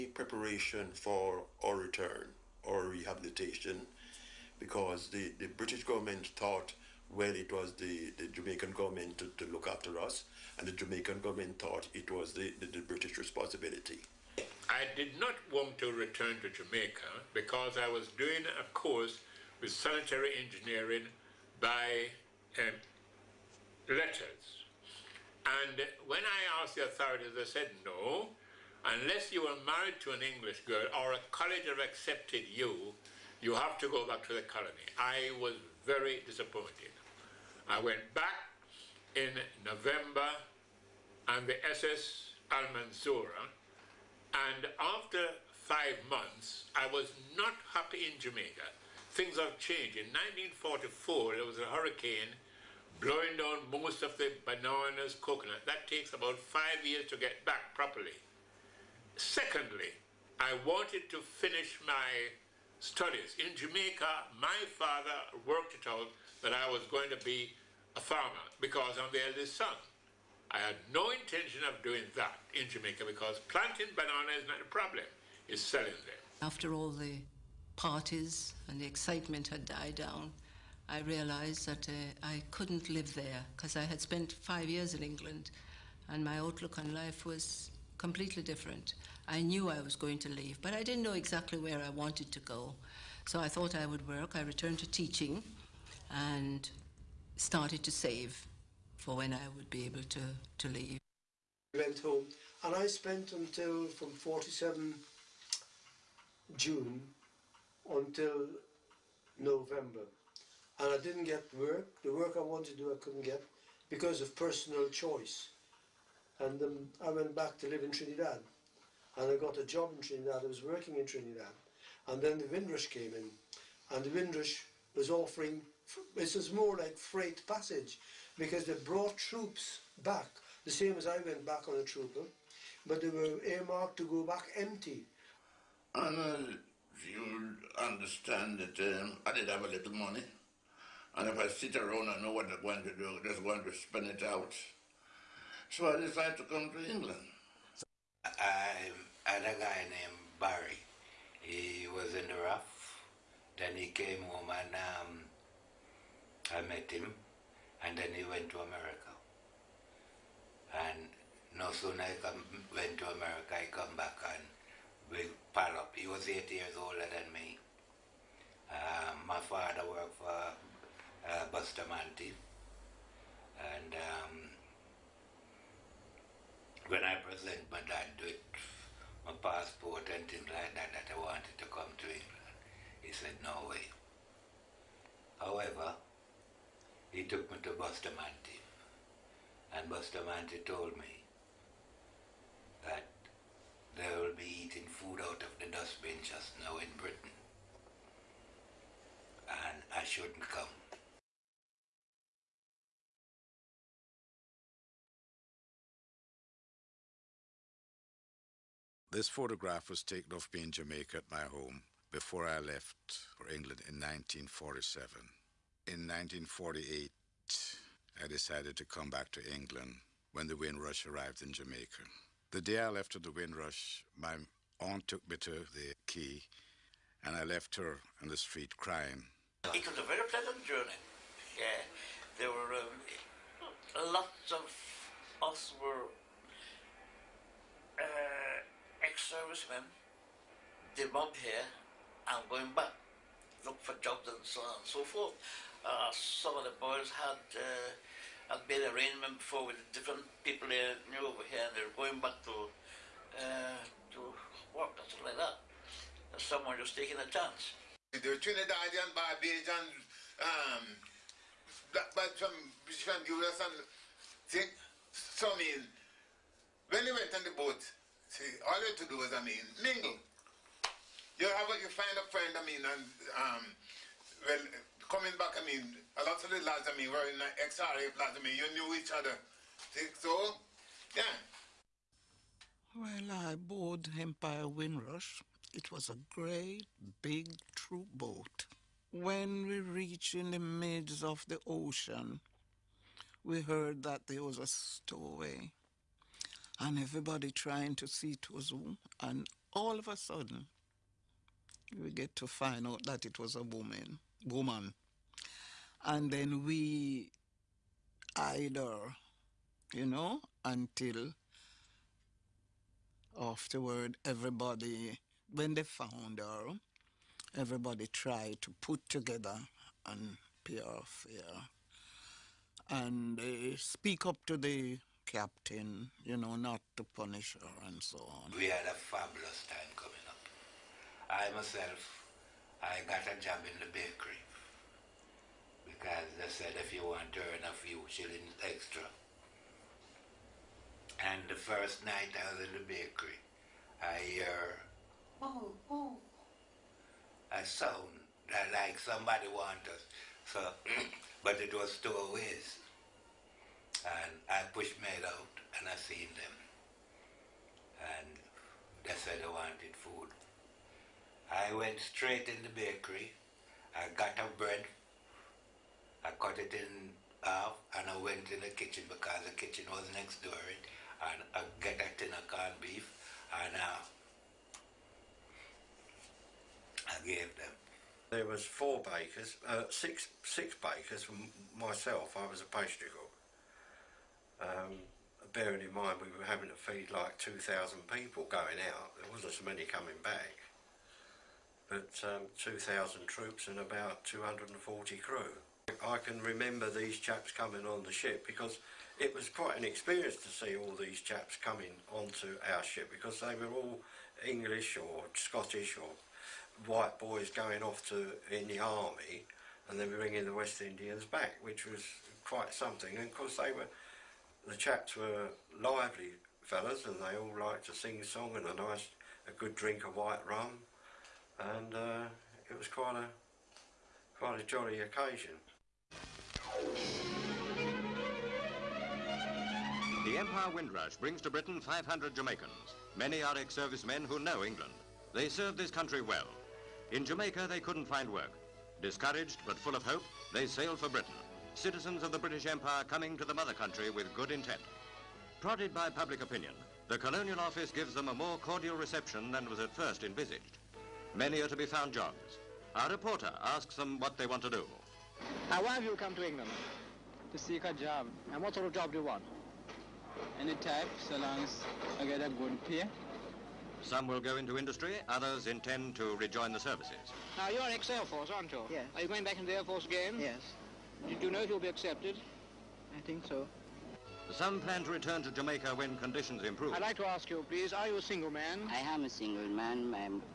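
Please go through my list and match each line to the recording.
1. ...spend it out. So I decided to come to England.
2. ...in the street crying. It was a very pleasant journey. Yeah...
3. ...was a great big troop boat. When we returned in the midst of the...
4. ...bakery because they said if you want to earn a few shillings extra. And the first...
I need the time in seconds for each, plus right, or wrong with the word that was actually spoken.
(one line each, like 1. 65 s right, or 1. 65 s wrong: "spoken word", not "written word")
1. 143 s right
2. 228 s right
3. 285 s wrong: "reached", not "returned"
4. 333 s right.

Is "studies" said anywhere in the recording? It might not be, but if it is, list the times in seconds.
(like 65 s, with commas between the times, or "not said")
62 s.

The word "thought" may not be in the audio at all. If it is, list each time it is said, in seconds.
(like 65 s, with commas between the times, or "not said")
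6 s, 11 s, 93 s.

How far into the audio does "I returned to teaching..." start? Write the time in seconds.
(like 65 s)
94 s.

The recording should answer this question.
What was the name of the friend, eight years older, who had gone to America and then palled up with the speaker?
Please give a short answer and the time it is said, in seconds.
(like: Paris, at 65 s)
Barry, at 150 s.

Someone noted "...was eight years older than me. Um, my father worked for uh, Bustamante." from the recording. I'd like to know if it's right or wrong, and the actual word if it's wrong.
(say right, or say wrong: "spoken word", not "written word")
right.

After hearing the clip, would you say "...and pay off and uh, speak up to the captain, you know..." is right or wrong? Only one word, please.
right.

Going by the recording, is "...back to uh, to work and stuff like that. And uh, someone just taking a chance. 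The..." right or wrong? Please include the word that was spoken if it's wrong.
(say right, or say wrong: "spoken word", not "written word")
right.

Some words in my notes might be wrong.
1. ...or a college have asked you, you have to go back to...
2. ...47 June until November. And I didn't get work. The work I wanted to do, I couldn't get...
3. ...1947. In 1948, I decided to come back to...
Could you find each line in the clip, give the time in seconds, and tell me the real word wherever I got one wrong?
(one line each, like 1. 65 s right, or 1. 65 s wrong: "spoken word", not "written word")
1. 31 s wrong: "accepted", not "asked"
2. 104 s right
3. 213 s right.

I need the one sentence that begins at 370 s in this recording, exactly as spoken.
It, and I get a tin of corned beef and uh, I gave them.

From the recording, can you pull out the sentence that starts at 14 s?
I did not want to return to Jamaica because I was doing a course with sanitary engineering by um, letters.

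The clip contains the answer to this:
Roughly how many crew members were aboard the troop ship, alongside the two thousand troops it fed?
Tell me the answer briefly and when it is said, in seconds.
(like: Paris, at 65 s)
240, at 394 s.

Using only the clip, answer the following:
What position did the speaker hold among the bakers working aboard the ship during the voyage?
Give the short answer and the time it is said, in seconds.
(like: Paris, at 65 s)
Pastry cook, at 382 s.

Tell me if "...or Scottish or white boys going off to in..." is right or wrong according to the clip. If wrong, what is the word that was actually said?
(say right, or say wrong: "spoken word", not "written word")
right.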